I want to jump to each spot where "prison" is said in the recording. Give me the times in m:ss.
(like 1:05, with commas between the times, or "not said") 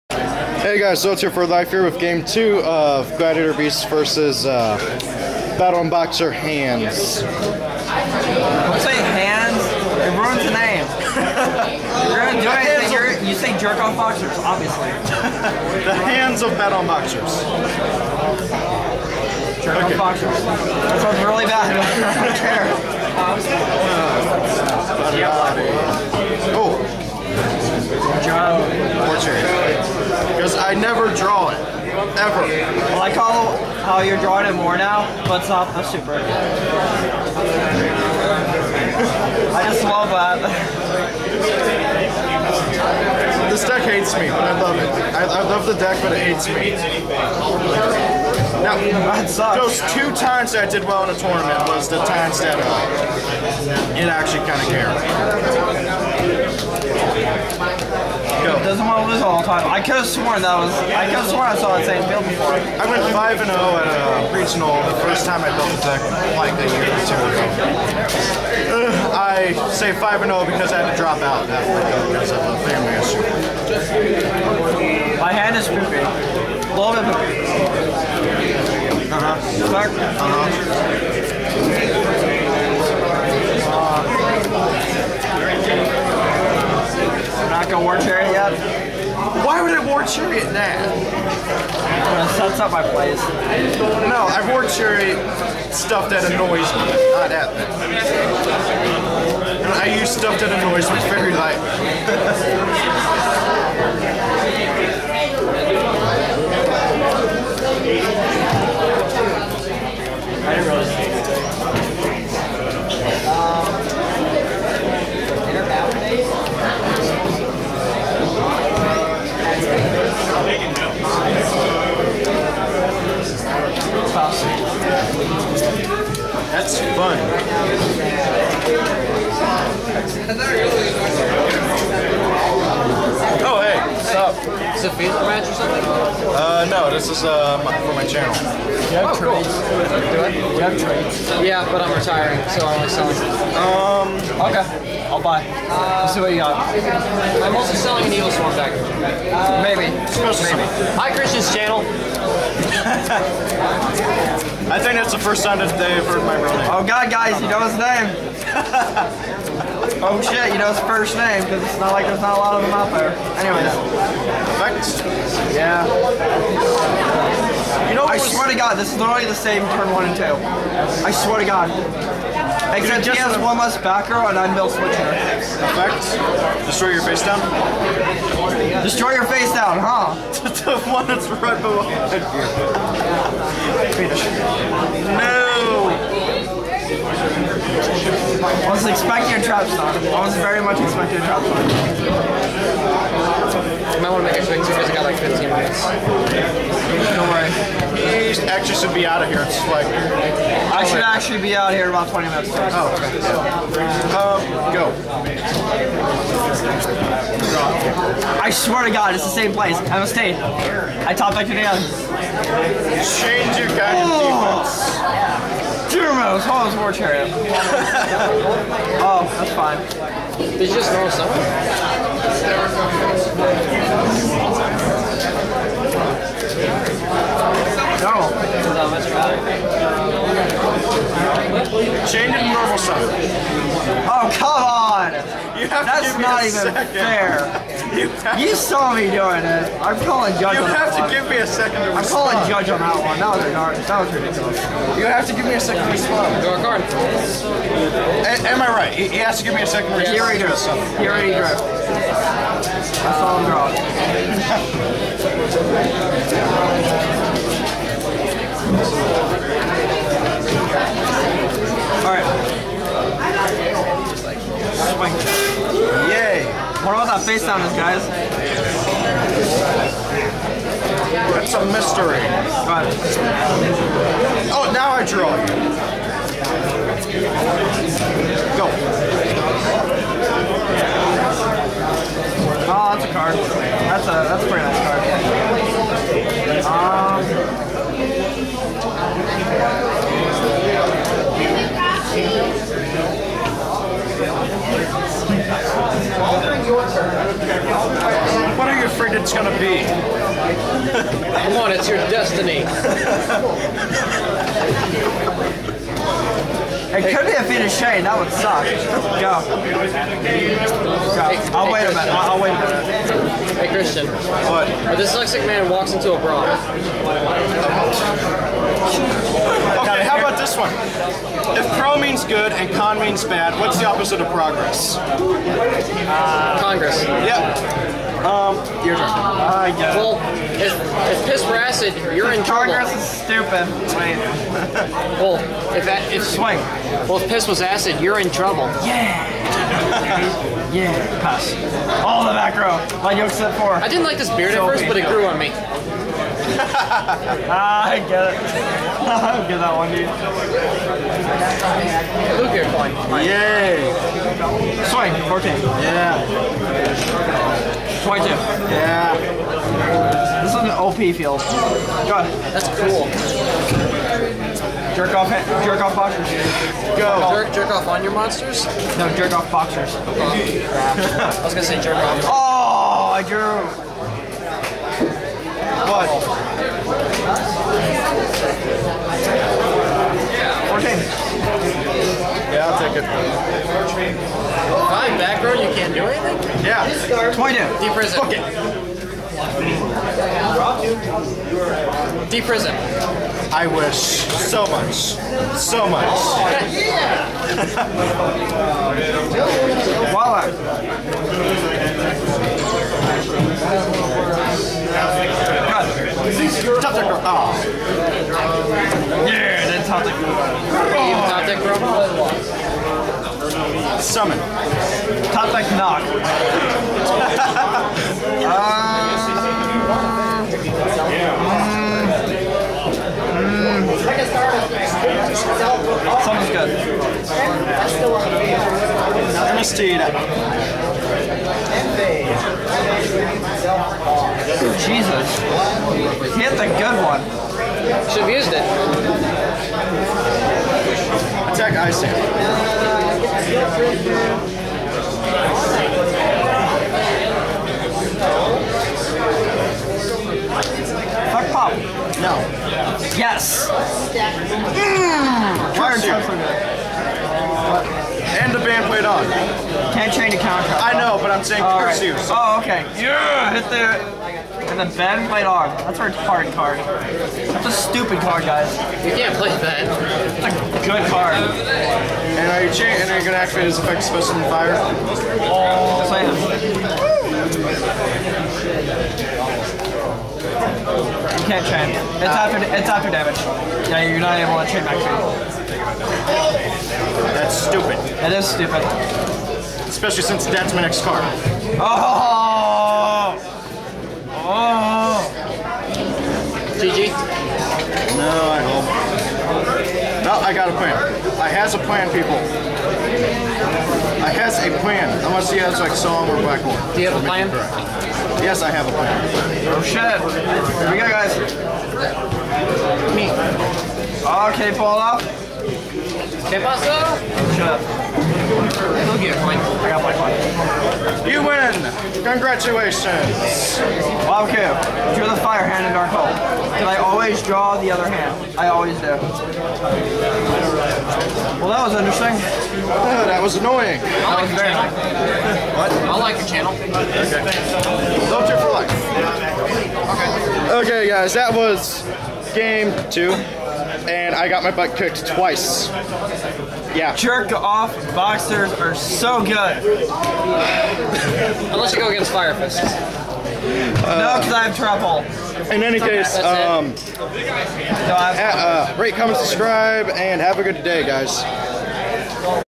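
6:27, 6:32.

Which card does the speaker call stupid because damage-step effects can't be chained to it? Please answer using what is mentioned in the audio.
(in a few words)
and the band played on.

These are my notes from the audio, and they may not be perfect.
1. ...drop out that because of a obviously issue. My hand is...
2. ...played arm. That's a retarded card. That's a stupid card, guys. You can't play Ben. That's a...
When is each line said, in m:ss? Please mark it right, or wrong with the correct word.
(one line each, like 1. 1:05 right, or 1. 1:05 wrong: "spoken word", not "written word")
1. 1:10 wrong: "family", not "obviously"
2. 7:45 right.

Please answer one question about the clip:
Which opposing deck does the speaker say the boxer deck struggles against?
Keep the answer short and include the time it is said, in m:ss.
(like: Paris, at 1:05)
Fire Fist, at 9:12.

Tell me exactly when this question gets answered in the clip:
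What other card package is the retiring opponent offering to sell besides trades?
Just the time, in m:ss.
2:28.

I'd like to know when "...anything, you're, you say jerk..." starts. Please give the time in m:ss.
0:12.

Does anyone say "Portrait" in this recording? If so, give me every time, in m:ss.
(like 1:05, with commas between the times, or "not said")
0:29.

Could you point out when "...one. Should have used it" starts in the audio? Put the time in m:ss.
7:17.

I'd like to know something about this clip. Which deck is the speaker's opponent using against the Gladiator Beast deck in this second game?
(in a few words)
Battlin Boxer.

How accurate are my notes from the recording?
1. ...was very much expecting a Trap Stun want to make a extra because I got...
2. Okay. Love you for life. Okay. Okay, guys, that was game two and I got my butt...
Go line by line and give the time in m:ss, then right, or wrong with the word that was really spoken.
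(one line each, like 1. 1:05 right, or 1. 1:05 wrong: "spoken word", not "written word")
1. 3:10 right
2. 8:56 right.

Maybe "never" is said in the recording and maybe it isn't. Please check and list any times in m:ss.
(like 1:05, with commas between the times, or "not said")
0:30.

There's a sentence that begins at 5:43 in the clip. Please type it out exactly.
I didn't like this beard so at first, but it grew on me ah, I get it.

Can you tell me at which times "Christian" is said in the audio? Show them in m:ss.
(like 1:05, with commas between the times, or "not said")
2:31, 5:13.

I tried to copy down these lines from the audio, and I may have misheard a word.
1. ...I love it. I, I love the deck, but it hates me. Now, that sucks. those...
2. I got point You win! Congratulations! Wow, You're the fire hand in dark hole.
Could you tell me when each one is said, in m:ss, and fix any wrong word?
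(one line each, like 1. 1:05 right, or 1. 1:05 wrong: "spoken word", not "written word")
1. 0:44 right
2. 8:39 right.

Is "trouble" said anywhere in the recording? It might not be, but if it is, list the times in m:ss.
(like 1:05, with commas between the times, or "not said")
5:32, 5:38, 9:14.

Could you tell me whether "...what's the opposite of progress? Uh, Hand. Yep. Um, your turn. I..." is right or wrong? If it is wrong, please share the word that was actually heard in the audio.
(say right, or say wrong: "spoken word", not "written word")
wrong: "Congress", not "Hand".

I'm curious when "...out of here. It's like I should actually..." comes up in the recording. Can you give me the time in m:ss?
3:19.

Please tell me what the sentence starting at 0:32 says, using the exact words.
Well, I call how you're drawing it more now, but it's not a super.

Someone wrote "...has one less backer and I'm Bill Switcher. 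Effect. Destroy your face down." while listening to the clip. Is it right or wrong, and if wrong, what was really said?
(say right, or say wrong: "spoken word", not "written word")
right.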